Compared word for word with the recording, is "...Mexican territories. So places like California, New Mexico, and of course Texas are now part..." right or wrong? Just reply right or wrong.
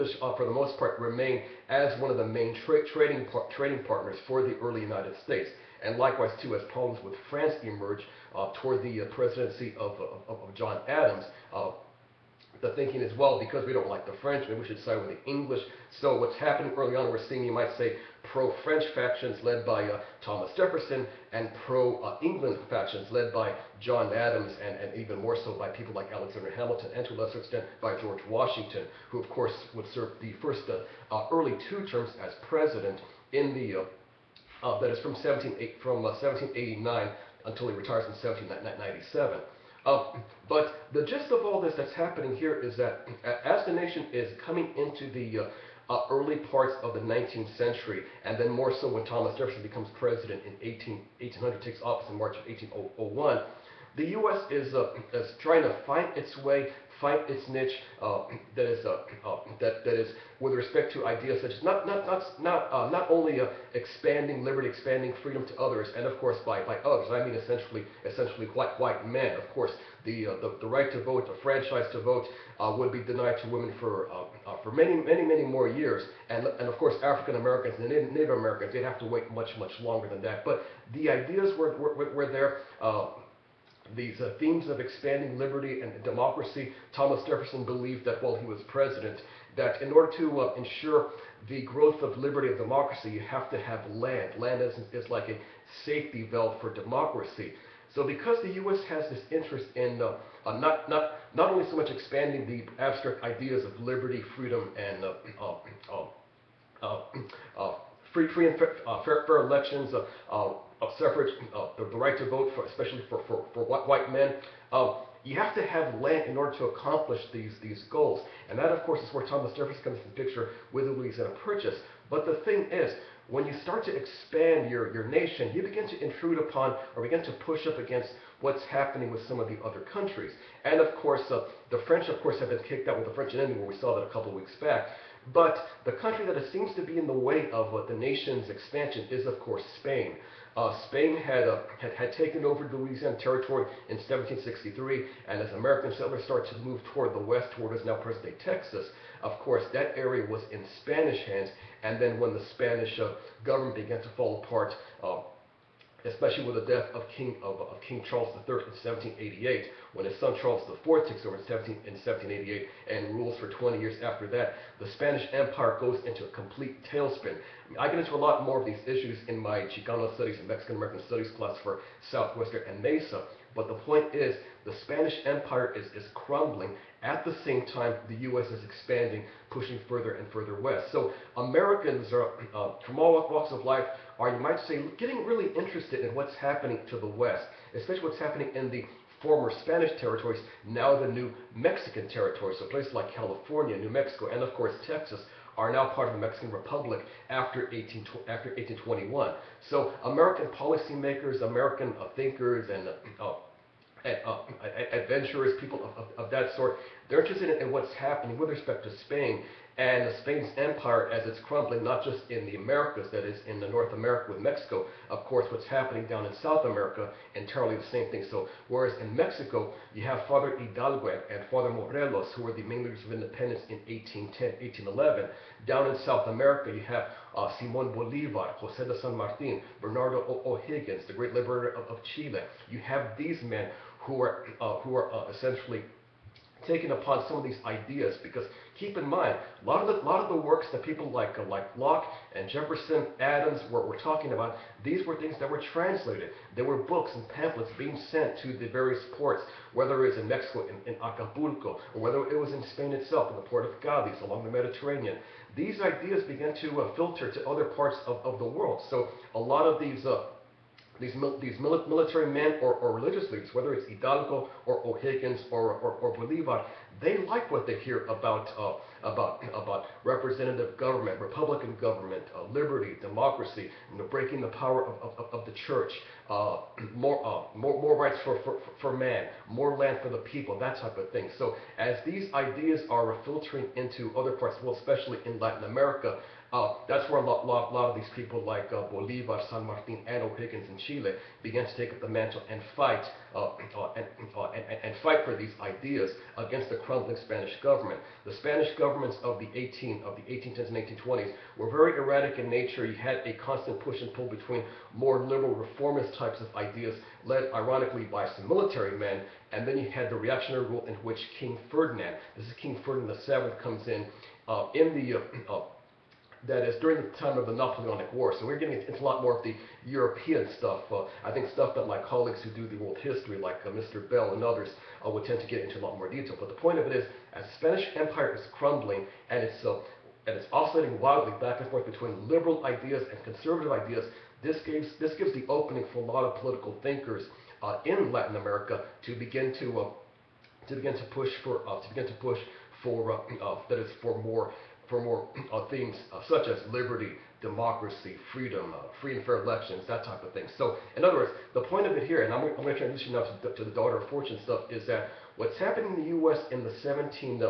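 right.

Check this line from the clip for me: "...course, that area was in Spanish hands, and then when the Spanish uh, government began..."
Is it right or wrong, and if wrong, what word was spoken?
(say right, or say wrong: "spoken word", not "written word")
right.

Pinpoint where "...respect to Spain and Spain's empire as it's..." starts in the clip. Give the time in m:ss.
3:28.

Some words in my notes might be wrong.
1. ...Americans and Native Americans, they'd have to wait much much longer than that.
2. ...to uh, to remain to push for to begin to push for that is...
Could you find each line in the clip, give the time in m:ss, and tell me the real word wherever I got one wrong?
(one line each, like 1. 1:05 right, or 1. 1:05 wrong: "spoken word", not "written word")
1. 1:17 right
2. 5:39 wrong: "begin", not "remain".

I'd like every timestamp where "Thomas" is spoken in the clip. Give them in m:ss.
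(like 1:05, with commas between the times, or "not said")
0:20, 0:49, 1:26, 1:59.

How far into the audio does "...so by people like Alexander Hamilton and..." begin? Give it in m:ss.
0:25.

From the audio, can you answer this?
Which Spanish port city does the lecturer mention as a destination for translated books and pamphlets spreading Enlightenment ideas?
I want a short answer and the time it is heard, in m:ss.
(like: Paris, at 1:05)
Cadiz, at 4:13.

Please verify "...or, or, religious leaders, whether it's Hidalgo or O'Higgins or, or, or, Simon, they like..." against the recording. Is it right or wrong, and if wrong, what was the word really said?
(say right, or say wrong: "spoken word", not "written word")
wrong: "Bolivar", not "Simon".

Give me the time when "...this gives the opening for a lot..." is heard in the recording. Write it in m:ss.
5:34.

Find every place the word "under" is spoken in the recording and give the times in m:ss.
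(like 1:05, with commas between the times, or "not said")
not said.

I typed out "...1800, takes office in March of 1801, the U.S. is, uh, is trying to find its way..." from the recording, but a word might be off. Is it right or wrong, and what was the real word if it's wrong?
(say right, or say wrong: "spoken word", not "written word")
right.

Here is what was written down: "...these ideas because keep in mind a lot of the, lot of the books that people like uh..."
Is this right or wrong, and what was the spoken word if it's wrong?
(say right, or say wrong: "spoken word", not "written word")
wrong: "works", not "books".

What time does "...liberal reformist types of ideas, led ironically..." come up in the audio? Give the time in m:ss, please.
5:05.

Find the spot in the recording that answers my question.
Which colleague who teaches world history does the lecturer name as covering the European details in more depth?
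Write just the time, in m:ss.
5:23.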